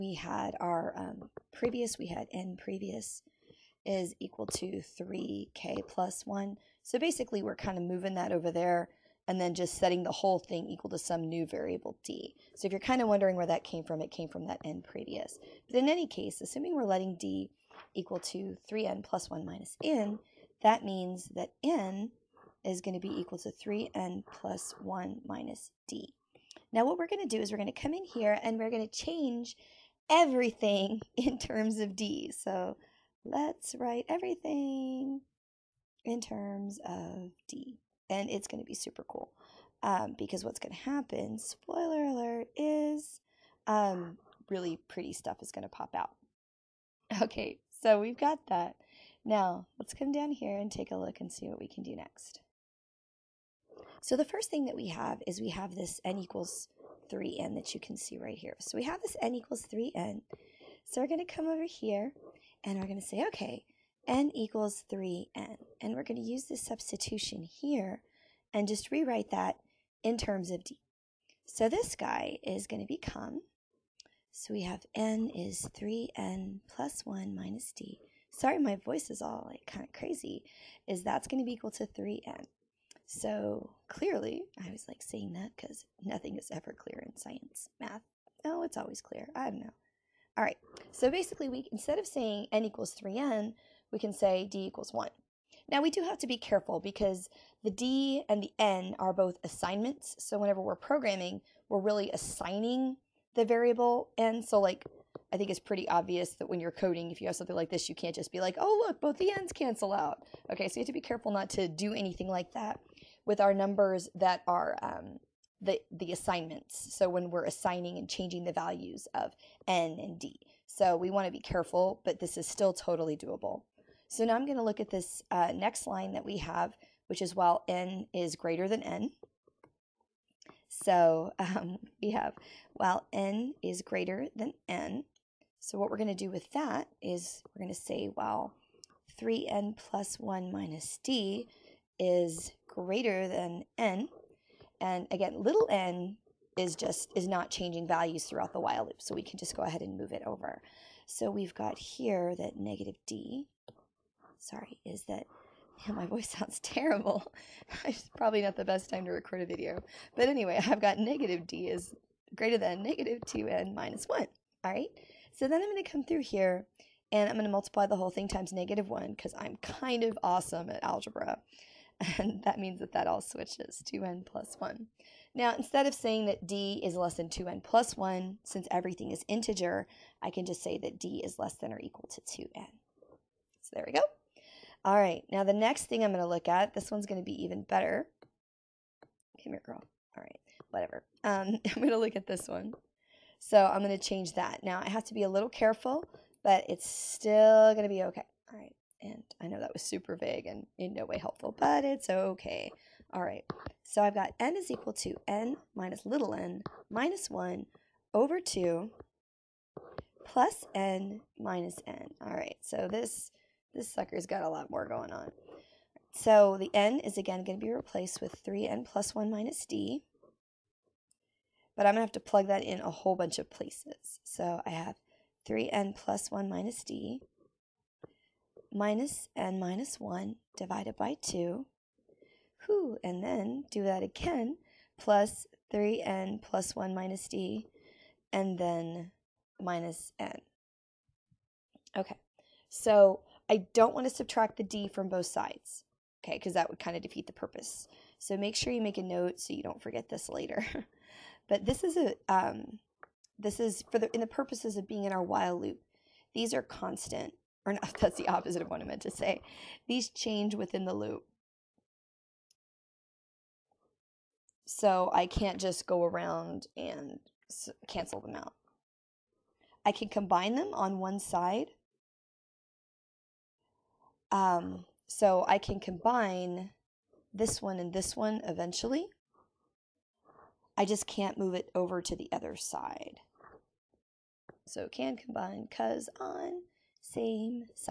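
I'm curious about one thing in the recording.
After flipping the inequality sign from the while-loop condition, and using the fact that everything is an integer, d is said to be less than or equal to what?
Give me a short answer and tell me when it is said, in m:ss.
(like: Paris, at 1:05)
2n, at 3:01.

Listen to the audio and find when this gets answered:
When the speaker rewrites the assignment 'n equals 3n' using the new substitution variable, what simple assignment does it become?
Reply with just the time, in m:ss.
1:34.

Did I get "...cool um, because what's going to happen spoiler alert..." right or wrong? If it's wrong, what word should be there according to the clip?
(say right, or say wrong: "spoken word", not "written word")
right.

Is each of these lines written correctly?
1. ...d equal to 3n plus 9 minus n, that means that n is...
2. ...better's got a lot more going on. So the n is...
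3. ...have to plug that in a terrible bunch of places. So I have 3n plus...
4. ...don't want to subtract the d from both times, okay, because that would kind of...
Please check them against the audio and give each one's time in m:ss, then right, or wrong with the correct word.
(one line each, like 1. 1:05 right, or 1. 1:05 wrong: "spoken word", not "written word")
1. 0:17 wrong: "1", not "9"
2. 3:33 wrong: "sucker", not "better"
3. 3:42 wrong: "whole", not "terrible"
4. 4:03 wrong: "sides", not "times".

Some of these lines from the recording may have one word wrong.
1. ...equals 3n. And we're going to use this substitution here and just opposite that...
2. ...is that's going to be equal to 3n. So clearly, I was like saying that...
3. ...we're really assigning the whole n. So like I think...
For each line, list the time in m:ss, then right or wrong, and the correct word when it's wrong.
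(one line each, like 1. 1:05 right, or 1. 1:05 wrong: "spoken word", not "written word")
1. 1:04 wrong: "rewrite", not "opposite"
2. 1:20 right
3. 1:41 wrong: "variable", not "whole".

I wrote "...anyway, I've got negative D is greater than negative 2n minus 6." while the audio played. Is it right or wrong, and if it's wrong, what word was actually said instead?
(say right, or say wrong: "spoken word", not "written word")
wrong: "1", not "6".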